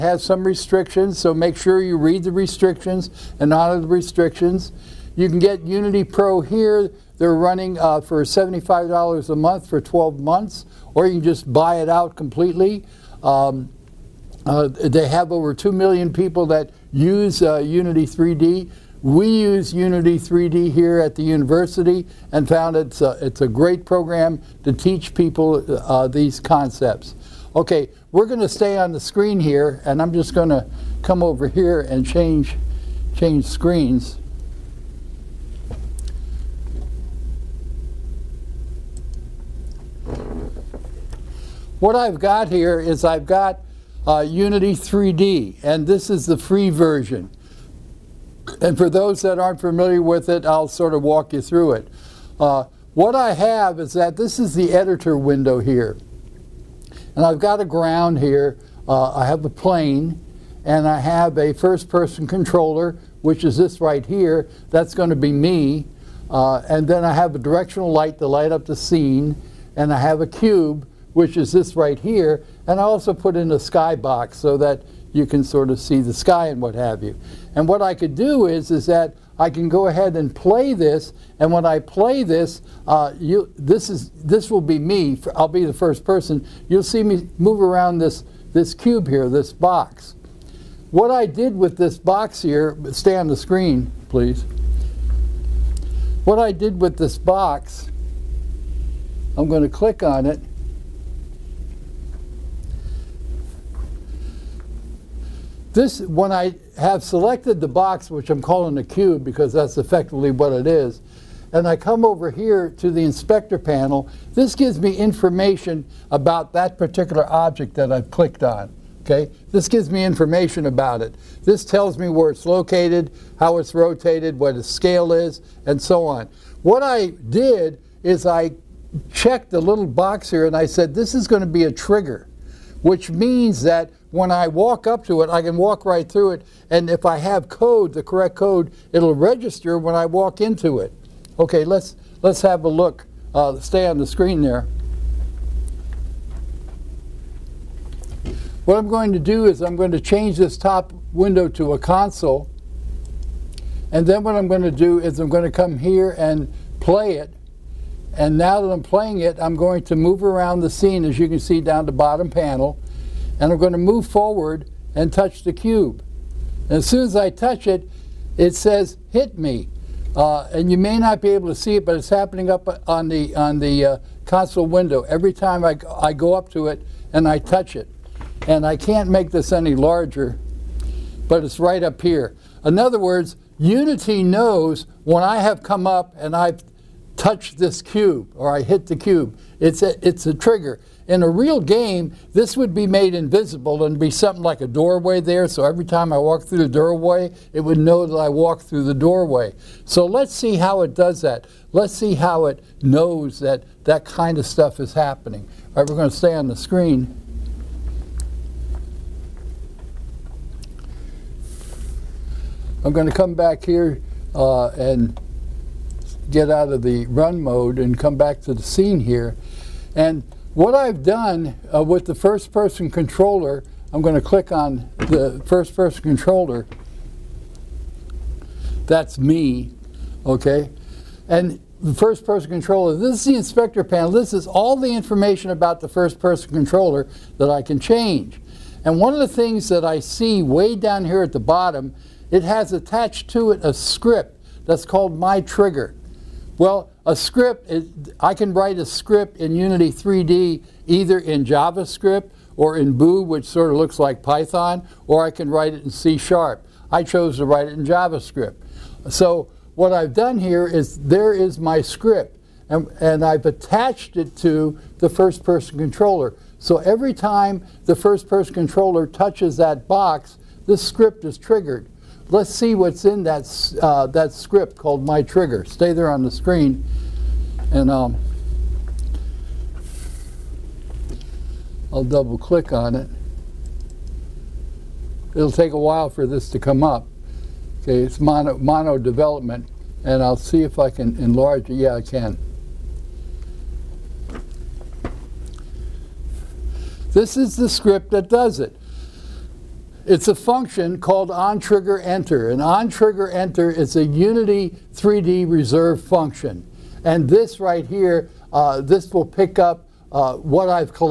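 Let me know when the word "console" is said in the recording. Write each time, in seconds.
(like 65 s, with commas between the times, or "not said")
151 s, 174 s.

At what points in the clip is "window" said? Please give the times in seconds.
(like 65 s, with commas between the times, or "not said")
55 s, 151 s, 174 s.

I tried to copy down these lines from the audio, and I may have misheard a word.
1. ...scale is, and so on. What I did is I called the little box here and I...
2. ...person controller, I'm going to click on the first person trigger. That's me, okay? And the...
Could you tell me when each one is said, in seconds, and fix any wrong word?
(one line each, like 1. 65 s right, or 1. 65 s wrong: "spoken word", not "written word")
1. 124 s wrong: "checked", not "called"
2. 222 s wrong: "controller", not "trigger".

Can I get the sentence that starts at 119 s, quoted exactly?
Okay, this gives me information about it.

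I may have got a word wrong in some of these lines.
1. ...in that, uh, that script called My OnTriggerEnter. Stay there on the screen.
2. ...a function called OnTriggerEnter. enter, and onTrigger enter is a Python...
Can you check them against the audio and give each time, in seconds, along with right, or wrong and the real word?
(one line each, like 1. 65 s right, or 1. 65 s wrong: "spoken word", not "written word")
1. 273 s wrong: "Trigger", not "OnTriggerEnter"
2. 300 s wrong: "Unity", not "Python".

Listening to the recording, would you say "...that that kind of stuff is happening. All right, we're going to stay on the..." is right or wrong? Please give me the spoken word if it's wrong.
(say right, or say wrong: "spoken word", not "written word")
right.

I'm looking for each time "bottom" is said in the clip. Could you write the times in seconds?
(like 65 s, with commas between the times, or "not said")
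161 s, 241 s.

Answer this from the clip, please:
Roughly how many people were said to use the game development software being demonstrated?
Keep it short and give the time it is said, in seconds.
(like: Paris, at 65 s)
over 2 million, at 15 s.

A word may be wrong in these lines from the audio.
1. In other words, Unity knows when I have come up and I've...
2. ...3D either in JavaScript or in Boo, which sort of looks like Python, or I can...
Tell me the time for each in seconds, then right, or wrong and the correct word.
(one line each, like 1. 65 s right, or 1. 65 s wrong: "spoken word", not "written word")
1. 182 s right
2. 249 s right.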